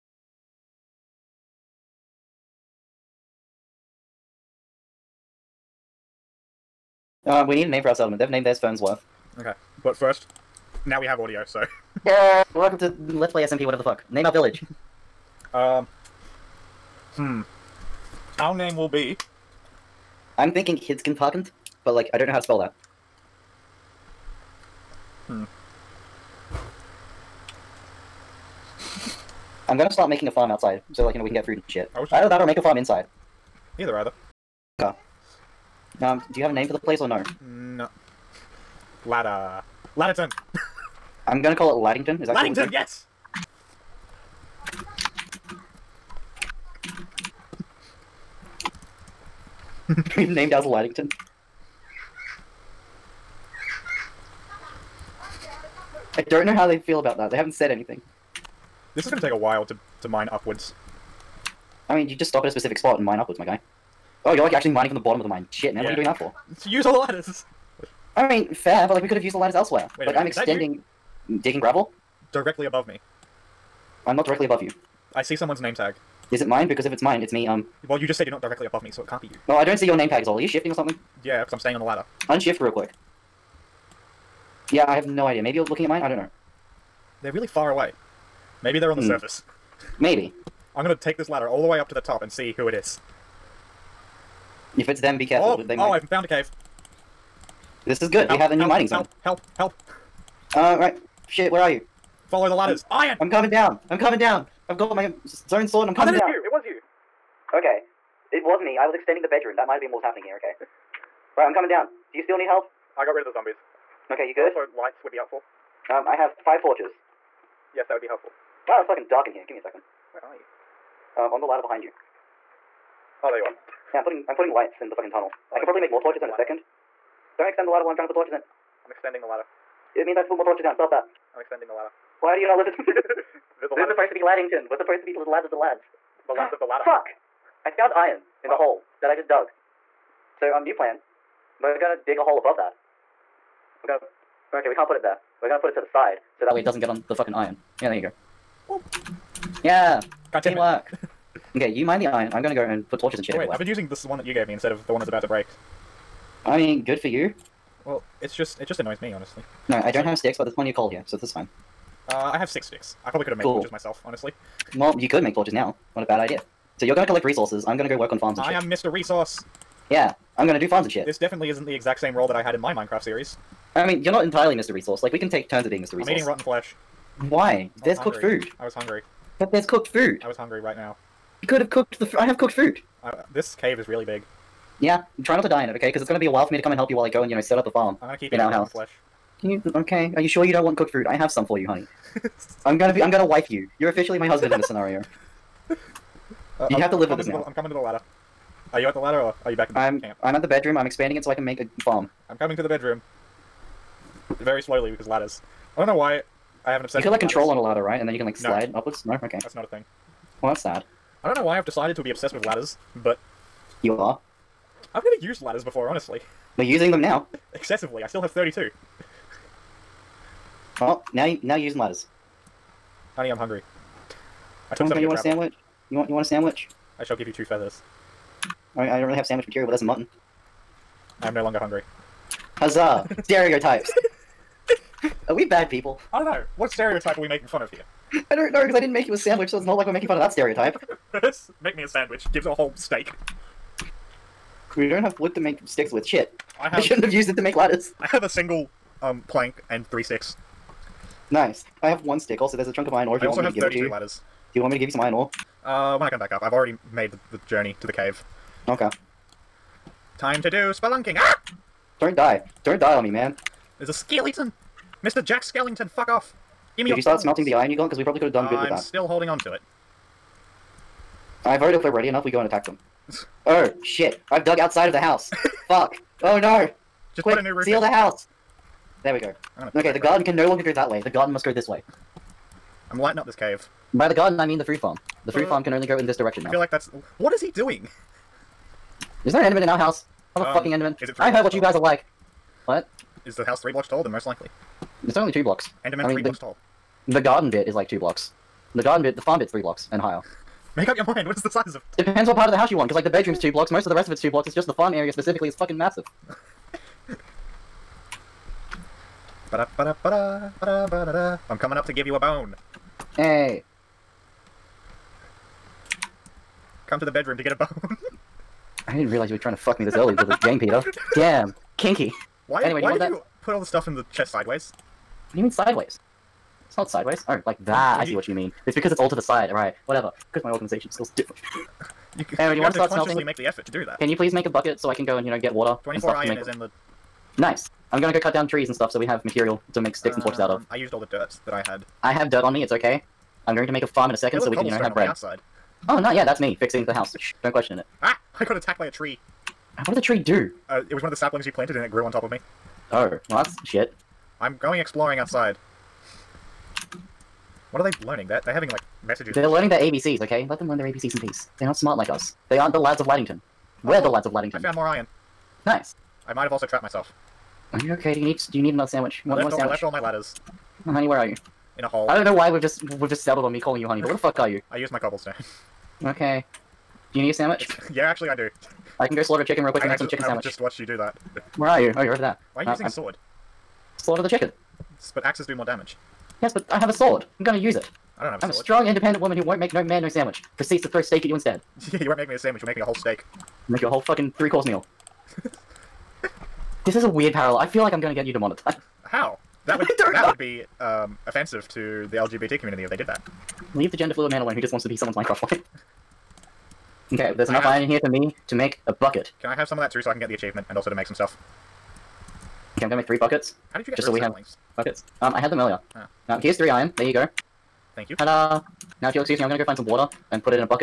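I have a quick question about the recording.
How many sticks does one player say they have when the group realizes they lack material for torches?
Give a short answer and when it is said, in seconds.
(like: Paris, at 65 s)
6, at 162 s.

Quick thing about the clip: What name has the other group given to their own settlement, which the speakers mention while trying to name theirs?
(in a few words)
Fernsworth.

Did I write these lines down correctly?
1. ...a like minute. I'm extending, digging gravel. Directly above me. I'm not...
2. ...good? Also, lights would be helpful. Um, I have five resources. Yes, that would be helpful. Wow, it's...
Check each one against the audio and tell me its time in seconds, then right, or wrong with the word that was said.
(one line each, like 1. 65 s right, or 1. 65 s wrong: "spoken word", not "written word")
1. 70 s right
2. 114 s wrong: "torches", not "resources".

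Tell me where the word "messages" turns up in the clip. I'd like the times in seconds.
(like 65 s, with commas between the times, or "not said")
359 s.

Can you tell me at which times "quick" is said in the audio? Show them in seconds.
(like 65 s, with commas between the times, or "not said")
82 s, 277 s, 379 s.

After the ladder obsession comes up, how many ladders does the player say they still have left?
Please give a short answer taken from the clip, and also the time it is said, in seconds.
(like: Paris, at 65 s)
32, at 218 s.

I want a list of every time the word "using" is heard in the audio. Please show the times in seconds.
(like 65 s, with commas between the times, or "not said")
153 s, 216 s, 221 s, 382 s.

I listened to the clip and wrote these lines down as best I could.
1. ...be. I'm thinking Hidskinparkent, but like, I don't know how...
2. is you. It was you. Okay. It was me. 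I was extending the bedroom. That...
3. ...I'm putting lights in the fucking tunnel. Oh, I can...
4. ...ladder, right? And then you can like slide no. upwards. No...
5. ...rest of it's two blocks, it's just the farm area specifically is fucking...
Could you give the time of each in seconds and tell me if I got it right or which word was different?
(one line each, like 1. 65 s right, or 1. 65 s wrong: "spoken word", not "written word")
1. 18 s right
2. 106 s right
3. 124 s right
4. 207 s right
5. 303 s right.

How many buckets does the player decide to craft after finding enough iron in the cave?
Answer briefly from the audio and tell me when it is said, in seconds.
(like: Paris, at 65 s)
3, at 413 s.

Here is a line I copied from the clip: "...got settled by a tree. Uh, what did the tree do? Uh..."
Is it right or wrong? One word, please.
wrong.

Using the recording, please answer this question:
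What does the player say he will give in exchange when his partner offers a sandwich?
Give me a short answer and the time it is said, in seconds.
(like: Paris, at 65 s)
two feathers, at 227 s.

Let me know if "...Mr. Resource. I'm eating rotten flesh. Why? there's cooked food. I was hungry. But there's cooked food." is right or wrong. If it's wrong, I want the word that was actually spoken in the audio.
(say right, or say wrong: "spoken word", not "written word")
right.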